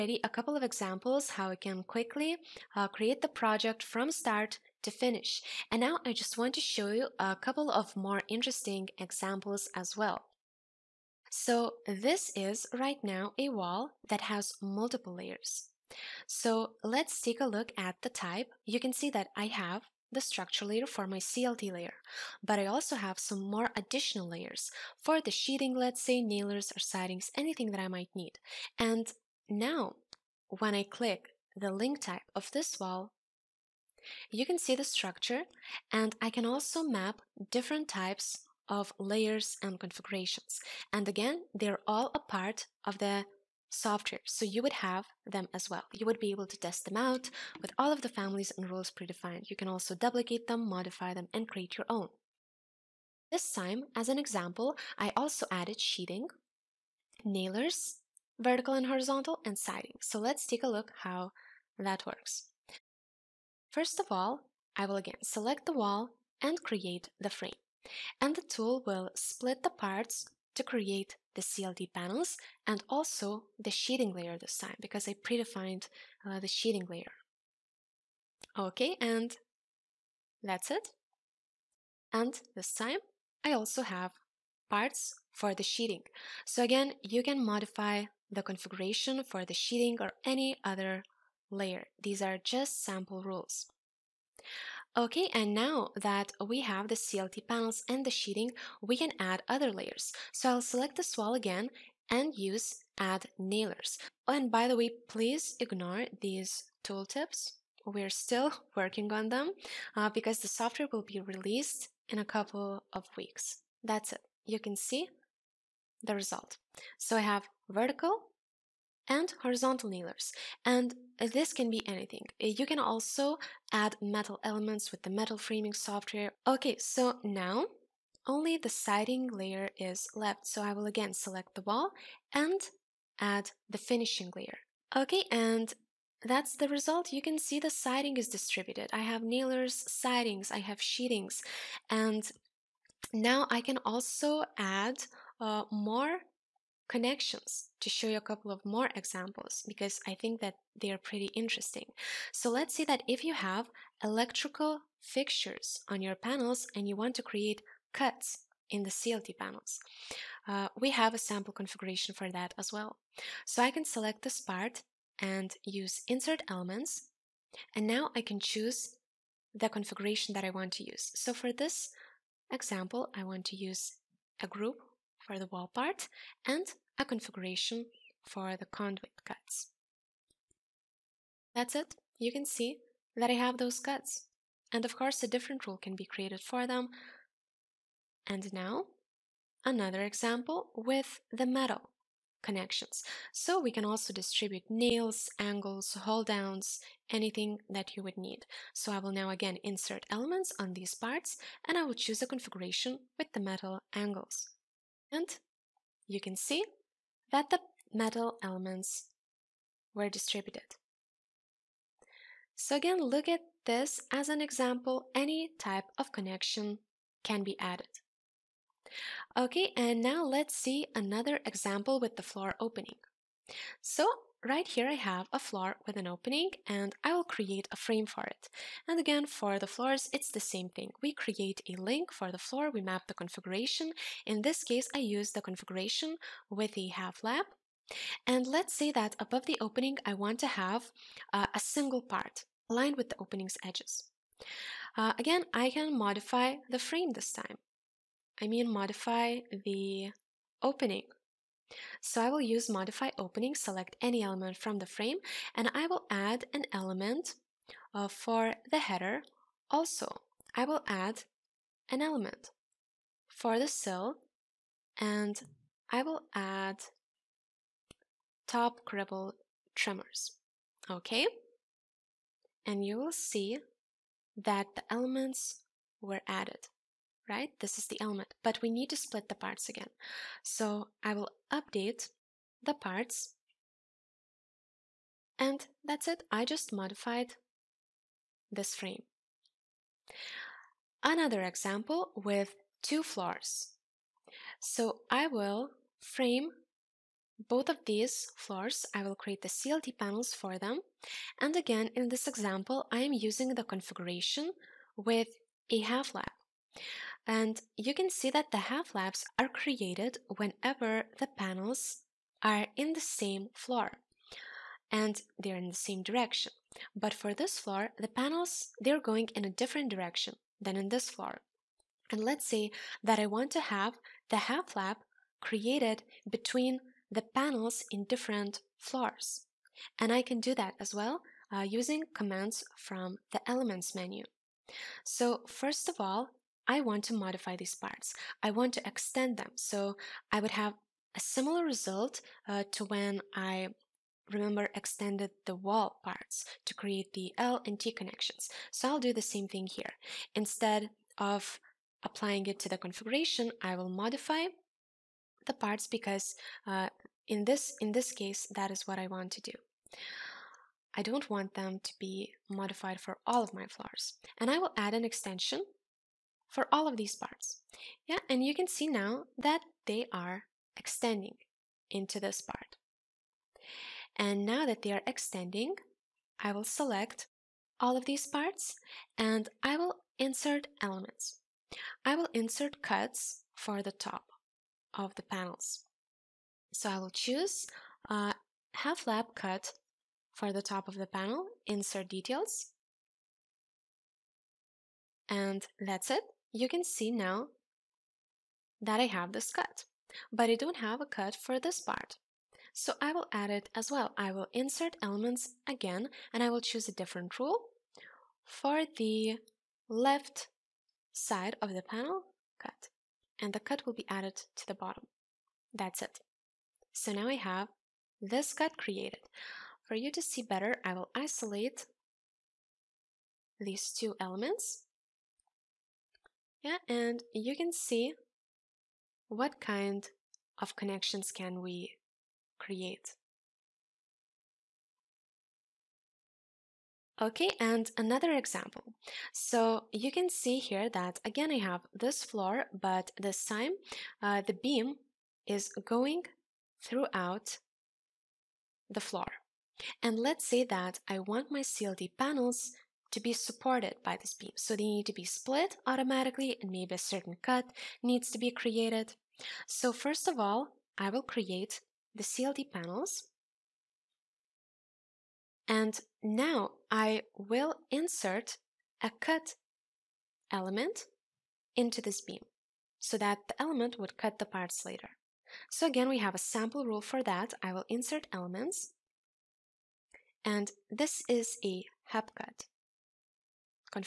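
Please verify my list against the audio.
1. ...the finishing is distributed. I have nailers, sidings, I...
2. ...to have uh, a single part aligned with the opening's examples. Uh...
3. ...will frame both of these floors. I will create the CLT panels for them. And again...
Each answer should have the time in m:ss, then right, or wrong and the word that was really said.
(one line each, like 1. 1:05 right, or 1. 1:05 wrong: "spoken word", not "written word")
1. 2:17 wrong: "siding", not "finishing"
2. 4:00 wrong: "edges", not "examples"
3. 4:55 right.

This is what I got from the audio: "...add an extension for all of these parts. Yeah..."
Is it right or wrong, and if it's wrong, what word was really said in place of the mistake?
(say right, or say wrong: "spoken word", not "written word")
right.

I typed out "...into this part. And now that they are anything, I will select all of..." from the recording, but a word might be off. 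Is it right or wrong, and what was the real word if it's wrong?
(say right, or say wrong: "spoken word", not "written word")
wrong: "extending", not "anything".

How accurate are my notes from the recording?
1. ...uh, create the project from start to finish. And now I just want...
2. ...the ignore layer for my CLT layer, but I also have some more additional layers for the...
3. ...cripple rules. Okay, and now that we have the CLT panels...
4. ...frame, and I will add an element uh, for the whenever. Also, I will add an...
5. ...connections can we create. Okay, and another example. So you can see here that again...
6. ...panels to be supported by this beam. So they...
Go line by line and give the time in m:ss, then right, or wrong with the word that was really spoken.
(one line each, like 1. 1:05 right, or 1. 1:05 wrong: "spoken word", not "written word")
1. 0:02 right
2. 0:20 wrong: "structure", not "ignore"
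3. 1:32 wrong: "sample", not "cripple"
4. 4:14 wrong: "header", not "whenever"
5. 7:10 right
6. 7:32 right.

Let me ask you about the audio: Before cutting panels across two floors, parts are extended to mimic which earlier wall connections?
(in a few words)
L and T connections.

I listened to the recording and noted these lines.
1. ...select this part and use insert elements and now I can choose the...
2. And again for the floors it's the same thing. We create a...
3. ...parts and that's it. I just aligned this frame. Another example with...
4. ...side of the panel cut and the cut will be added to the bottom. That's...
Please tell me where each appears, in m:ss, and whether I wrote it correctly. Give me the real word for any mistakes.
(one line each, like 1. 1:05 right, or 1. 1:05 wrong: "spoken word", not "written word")
1. 2:43 right
2. 3:48 right
3. 4:42 wrong: "modified", not "aligned"
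4. 6:51 right.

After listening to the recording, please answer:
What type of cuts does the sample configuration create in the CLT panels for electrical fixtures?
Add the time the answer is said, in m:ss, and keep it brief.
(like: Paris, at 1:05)
conduit cuts, at 2:58.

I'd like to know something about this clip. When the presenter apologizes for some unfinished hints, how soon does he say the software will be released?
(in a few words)
a couple of weeks.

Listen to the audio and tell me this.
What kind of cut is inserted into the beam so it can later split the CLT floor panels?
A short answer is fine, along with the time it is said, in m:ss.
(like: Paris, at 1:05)
hub cut, at 8:02.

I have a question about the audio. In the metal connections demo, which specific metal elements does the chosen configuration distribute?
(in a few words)
metal angles.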